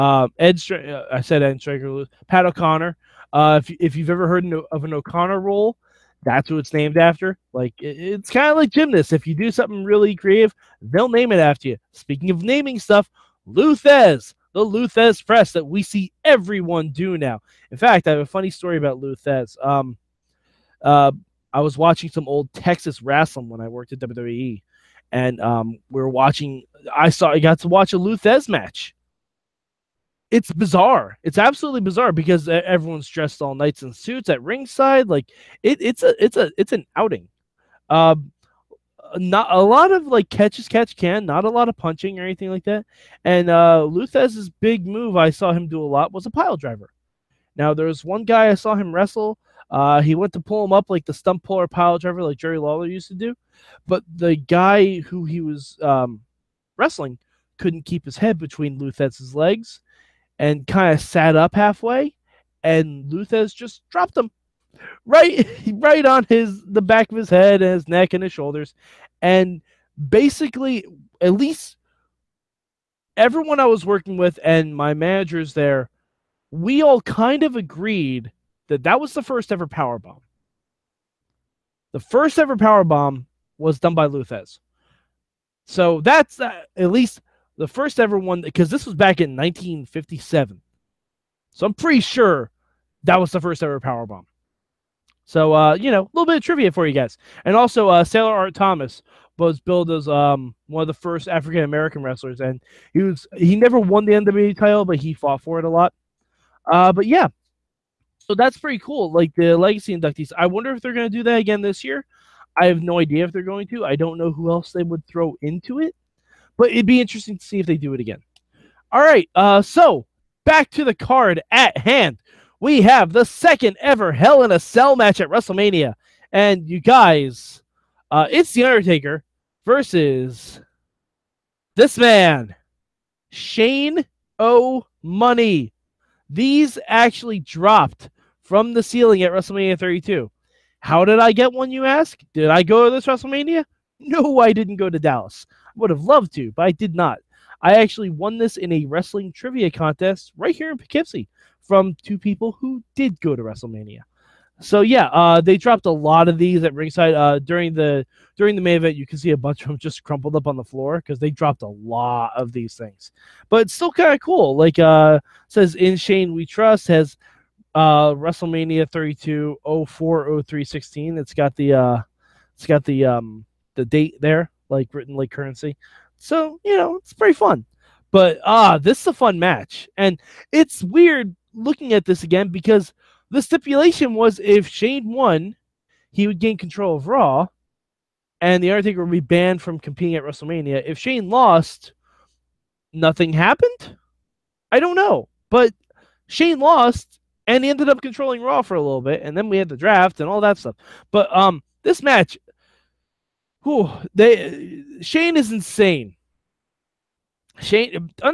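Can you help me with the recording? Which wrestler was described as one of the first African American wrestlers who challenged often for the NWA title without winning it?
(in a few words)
Sailor Art Thomas.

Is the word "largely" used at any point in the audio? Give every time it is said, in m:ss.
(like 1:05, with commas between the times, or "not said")
not said.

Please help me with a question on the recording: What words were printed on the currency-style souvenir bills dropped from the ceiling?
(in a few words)
In Shane we trust.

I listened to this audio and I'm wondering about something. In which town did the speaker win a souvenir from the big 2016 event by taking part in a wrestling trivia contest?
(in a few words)
Poughkeepsie.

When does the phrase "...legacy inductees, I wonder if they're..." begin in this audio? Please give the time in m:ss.
1:49.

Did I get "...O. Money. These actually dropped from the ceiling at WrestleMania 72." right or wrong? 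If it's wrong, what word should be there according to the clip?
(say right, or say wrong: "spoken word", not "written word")
wrong: "32", not "72".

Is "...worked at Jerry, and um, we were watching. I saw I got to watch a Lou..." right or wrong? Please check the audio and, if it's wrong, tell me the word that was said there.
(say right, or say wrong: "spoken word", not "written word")
wrong: "WWE", not "Jerry".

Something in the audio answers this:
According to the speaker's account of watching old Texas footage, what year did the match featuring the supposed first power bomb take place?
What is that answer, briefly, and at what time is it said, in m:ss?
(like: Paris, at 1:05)
1957, at 1:29.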